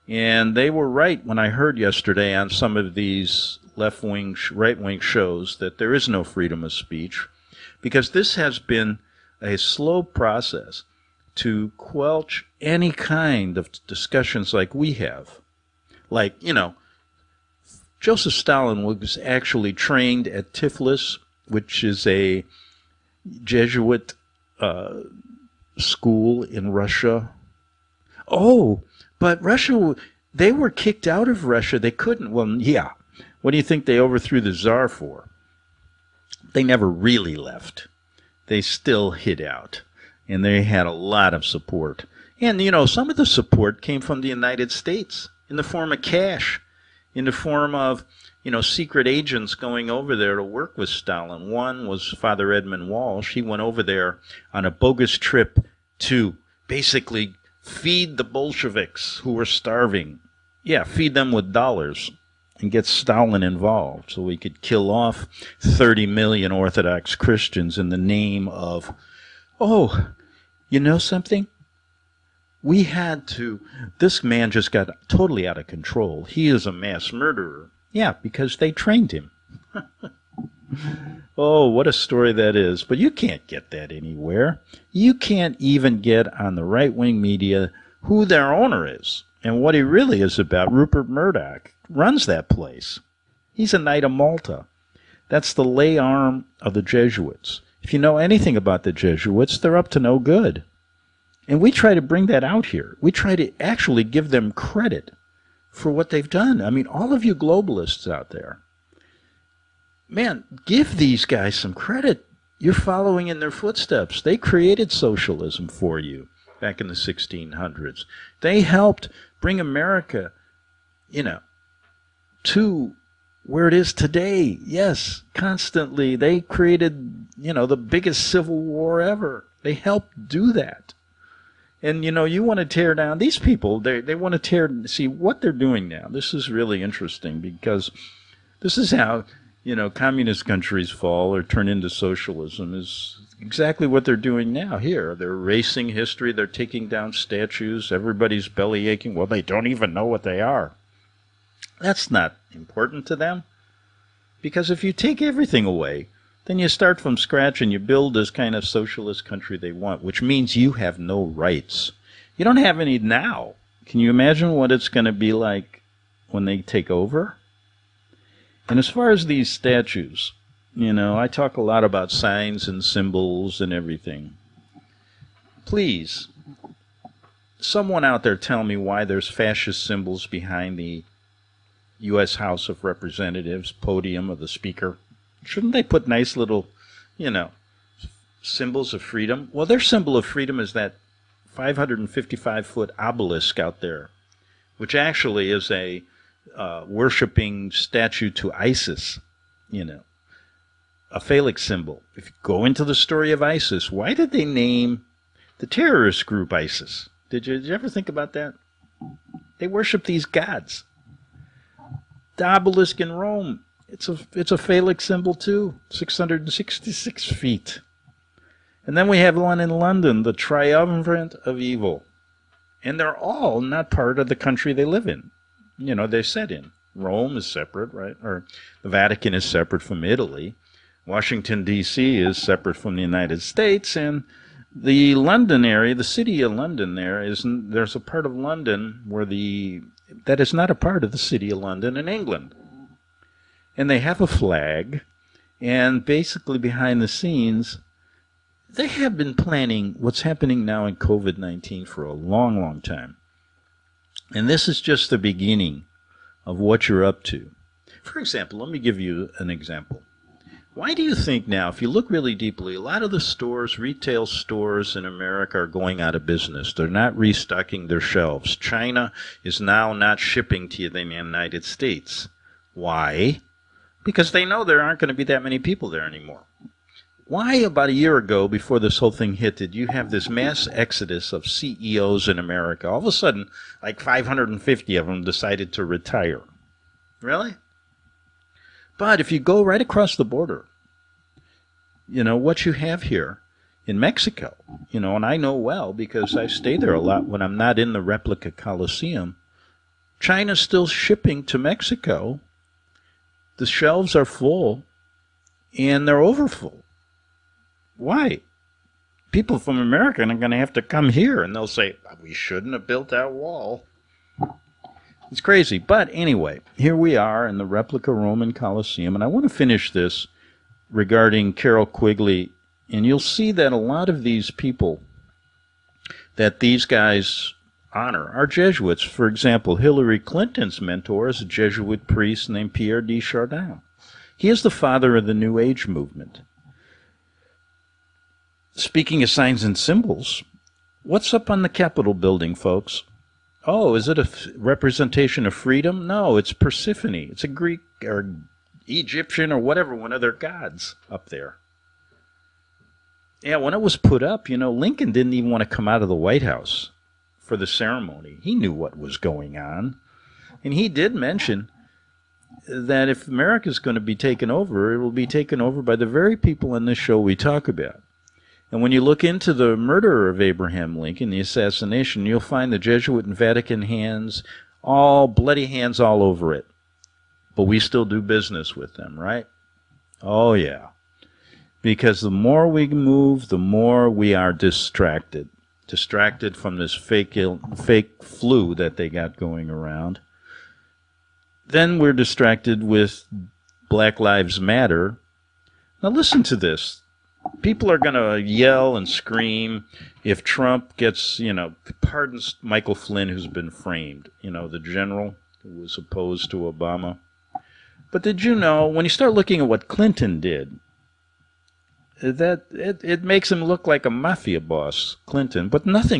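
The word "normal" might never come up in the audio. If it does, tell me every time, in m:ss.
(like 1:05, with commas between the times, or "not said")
not said.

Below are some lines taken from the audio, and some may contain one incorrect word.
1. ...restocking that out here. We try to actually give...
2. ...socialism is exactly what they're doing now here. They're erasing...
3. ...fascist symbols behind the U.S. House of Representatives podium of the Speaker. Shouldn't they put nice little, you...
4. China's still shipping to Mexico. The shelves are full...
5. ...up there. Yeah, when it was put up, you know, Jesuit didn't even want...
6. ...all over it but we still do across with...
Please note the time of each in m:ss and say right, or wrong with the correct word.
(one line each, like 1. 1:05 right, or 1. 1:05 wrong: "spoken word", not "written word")
1. 1:42 wrong: "bring", not "restocking"
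2. 2:21 right
3. 2:59 right
4. 5:00 right
5. 5:51 wrong: "Lincoln", not "Jesuit"
6. 6:15 wrong: "business", not "across".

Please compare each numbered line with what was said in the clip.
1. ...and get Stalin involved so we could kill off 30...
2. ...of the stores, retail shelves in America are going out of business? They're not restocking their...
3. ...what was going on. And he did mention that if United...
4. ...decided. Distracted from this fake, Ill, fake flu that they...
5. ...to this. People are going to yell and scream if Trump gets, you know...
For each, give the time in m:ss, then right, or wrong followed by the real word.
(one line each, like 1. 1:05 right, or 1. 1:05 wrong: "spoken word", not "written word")
1. 1:02 right
2. 4:23 wrong: "stores", not "shelves"
3. 5:58 wrong: "America", not "United"
4. 6:24 wrong: "distracted", not "decided"
5. 6:36 right.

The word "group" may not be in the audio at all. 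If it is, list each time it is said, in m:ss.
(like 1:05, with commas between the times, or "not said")
3:26.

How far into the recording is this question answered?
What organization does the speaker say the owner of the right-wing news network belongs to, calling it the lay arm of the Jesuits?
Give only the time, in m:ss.
1:33.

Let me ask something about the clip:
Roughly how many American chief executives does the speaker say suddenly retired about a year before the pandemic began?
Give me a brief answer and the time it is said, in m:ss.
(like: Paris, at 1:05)
550, at 4:44.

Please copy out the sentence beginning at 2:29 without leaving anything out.
Well, they don't even know what they are.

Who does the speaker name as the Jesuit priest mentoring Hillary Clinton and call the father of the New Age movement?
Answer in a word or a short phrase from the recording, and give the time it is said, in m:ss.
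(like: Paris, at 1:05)
Pierre de Chardin, at 5:32.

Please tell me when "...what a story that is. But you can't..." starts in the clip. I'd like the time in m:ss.
1:21.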